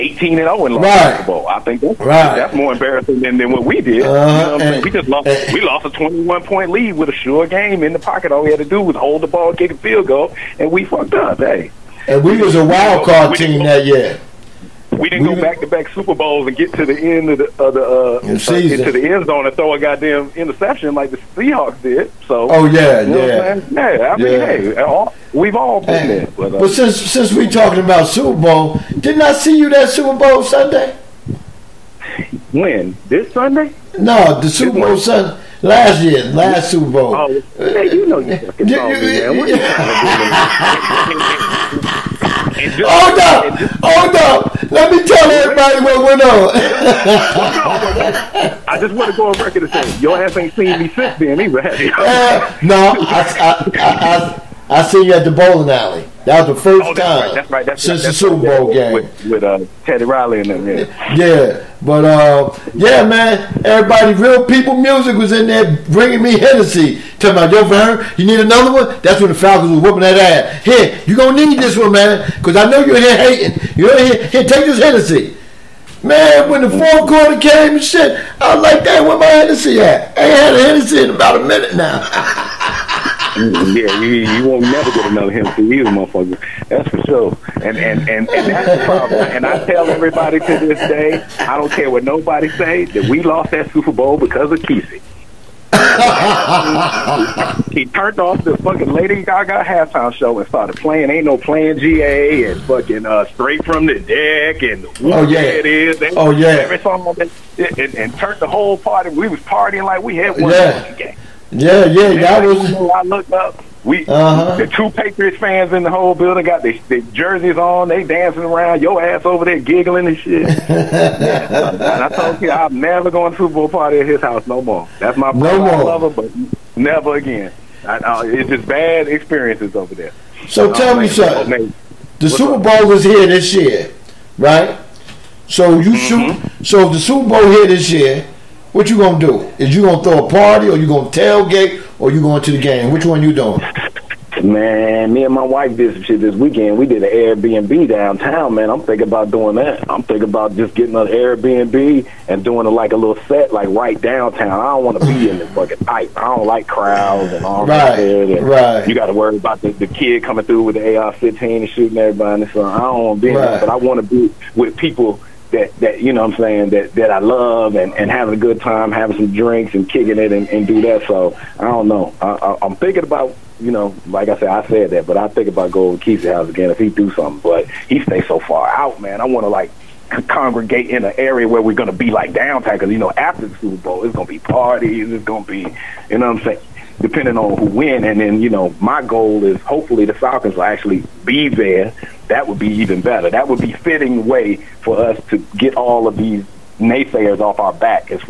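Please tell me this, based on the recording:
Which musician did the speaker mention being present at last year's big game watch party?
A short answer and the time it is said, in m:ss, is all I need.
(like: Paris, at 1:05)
Teddy Riley, at 0:59.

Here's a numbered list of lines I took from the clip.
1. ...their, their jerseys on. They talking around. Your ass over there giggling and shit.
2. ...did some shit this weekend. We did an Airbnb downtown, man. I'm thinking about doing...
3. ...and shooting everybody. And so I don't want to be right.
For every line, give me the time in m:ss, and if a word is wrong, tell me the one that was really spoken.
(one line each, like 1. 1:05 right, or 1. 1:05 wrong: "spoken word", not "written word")
1. 1:56 wrong: "dancing", not "talking"
2. 2:25 right
3. 2:41 right.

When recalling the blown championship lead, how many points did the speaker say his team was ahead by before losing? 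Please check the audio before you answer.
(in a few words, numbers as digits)
21.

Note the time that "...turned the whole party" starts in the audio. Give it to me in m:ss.
1:48.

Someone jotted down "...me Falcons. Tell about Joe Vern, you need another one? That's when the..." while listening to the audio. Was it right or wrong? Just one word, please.
wrong.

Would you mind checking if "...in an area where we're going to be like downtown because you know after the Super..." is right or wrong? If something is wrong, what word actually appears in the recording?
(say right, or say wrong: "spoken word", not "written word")
right.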